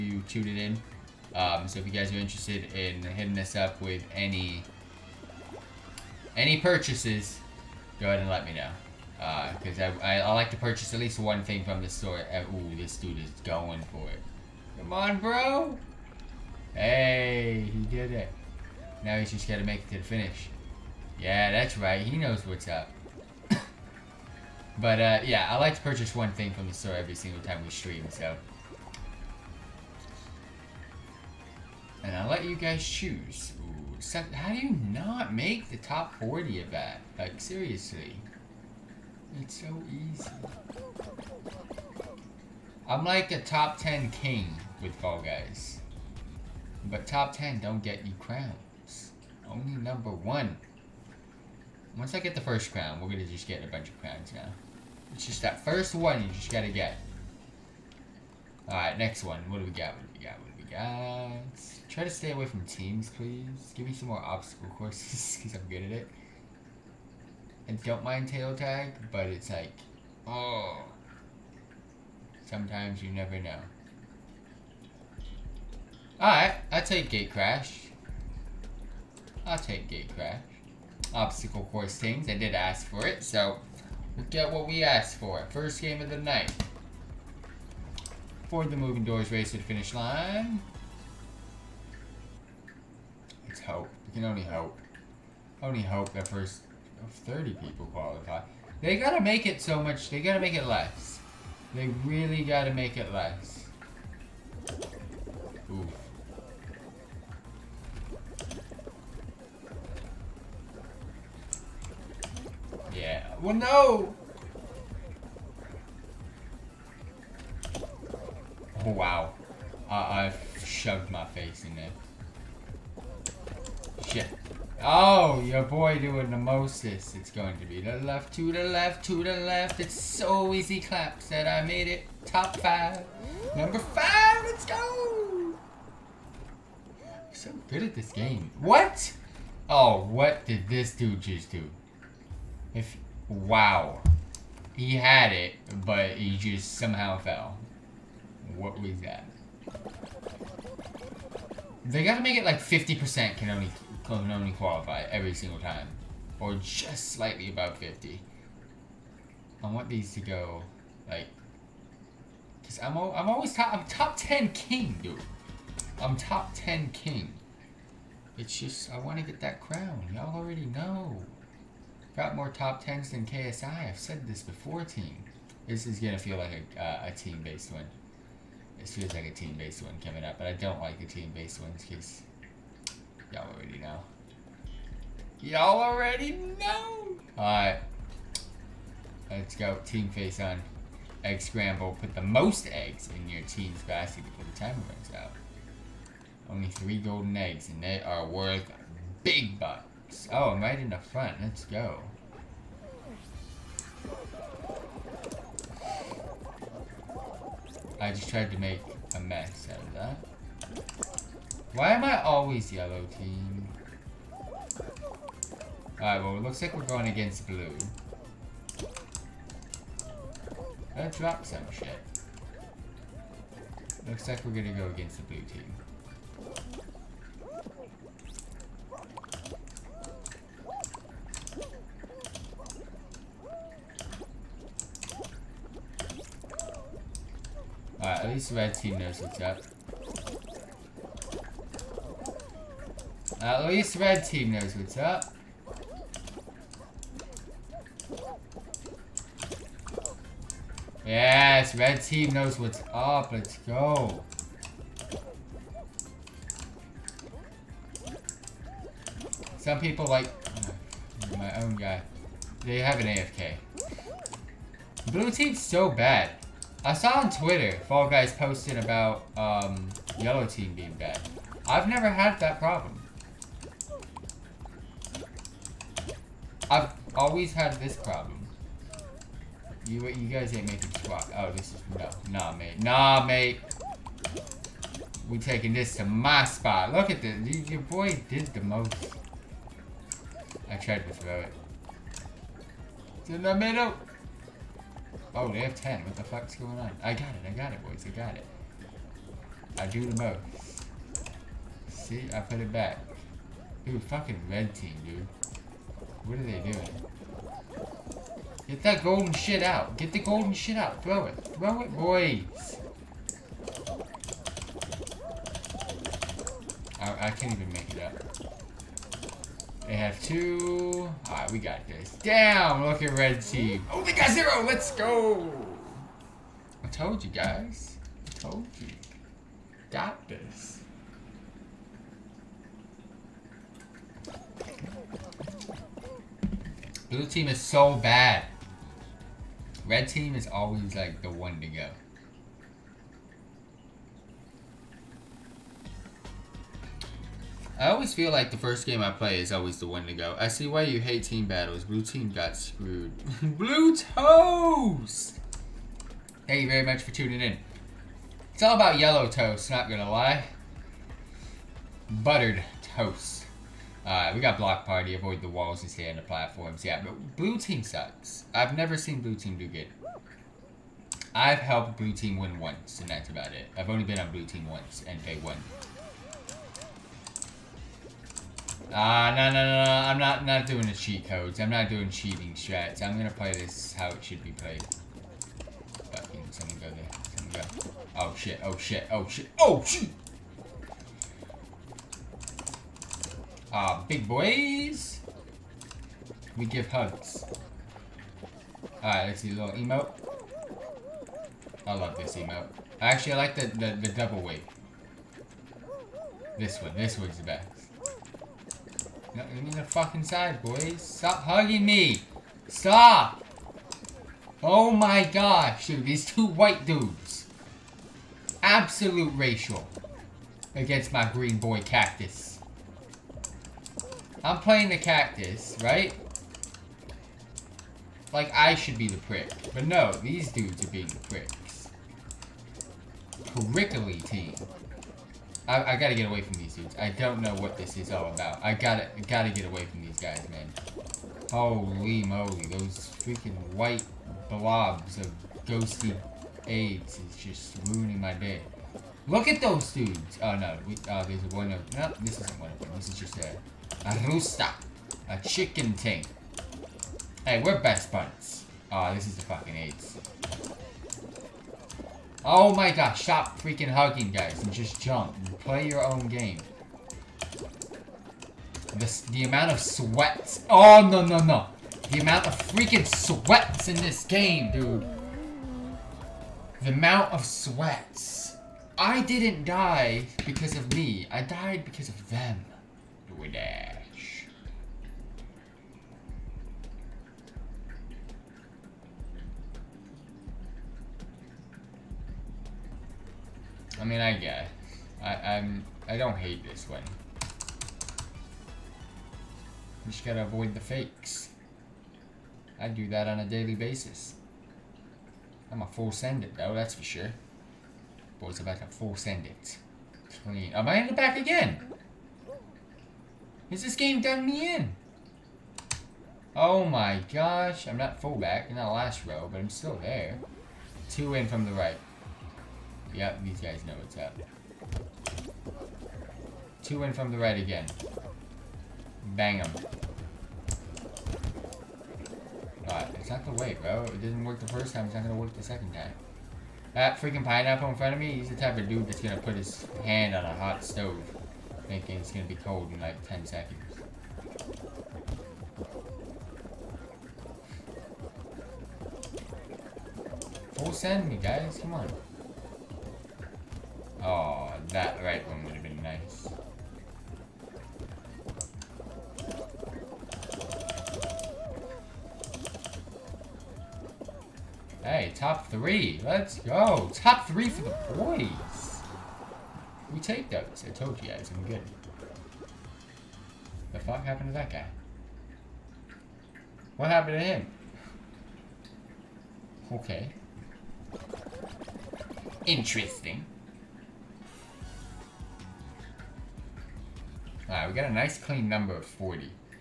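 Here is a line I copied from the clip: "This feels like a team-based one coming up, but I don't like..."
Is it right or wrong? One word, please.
right.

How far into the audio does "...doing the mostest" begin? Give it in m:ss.
2:05.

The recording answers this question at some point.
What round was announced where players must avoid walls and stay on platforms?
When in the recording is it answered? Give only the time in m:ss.
6:04.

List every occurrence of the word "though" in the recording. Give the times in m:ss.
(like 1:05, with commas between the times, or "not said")
8:26.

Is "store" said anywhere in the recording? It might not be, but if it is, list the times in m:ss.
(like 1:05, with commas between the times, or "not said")
0:11, 0:26.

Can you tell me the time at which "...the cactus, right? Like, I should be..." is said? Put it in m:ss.
7:04.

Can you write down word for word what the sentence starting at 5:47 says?
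I always feel like the first game I play is always the one to go.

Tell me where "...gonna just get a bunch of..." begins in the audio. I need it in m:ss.
0:53.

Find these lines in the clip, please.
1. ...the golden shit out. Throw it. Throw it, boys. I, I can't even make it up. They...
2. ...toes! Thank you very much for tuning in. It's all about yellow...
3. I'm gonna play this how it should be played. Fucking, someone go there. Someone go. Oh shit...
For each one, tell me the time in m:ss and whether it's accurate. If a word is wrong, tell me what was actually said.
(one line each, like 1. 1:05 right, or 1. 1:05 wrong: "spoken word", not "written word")
1. 5:10 right
2. 5:53 right
3. 6:23 right.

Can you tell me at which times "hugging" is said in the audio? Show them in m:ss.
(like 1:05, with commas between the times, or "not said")
6:51, 7:43.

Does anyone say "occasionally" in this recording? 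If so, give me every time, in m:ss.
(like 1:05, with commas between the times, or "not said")
not said.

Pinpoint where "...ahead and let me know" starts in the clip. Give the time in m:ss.
0:08.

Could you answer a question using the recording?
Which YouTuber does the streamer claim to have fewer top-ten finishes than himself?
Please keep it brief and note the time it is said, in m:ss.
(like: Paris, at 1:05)
KSI, at 2:53.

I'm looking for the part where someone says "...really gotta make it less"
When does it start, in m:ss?
1:42.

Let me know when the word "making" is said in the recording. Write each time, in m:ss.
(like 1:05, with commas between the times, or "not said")
4:40.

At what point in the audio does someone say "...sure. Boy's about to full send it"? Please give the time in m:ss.
8:27.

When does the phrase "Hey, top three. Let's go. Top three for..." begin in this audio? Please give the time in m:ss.
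9:25.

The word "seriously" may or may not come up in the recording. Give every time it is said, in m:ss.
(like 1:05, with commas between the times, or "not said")
0:37.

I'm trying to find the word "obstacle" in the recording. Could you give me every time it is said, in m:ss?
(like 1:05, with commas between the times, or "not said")
1:04, 1:21.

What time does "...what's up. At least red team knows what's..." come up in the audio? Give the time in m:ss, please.
3:59.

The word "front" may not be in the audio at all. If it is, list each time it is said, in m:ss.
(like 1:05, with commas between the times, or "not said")
3:20, 8:57.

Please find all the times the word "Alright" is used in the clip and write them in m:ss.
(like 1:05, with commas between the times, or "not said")
0:58, 1:16, 3:07, 3:35, 5:21, 6:39, 9:47.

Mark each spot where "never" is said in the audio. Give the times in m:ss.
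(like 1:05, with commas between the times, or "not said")
1:13, 4:31, 6:08.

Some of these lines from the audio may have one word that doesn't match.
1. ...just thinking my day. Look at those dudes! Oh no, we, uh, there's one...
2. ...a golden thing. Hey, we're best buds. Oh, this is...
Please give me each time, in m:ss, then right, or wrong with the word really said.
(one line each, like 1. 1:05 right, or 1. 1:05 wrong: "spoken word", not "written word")
1. 7:27 wrong: "ruining", not "thinking"
2. 7:35 wrong: "chicken", not "golden".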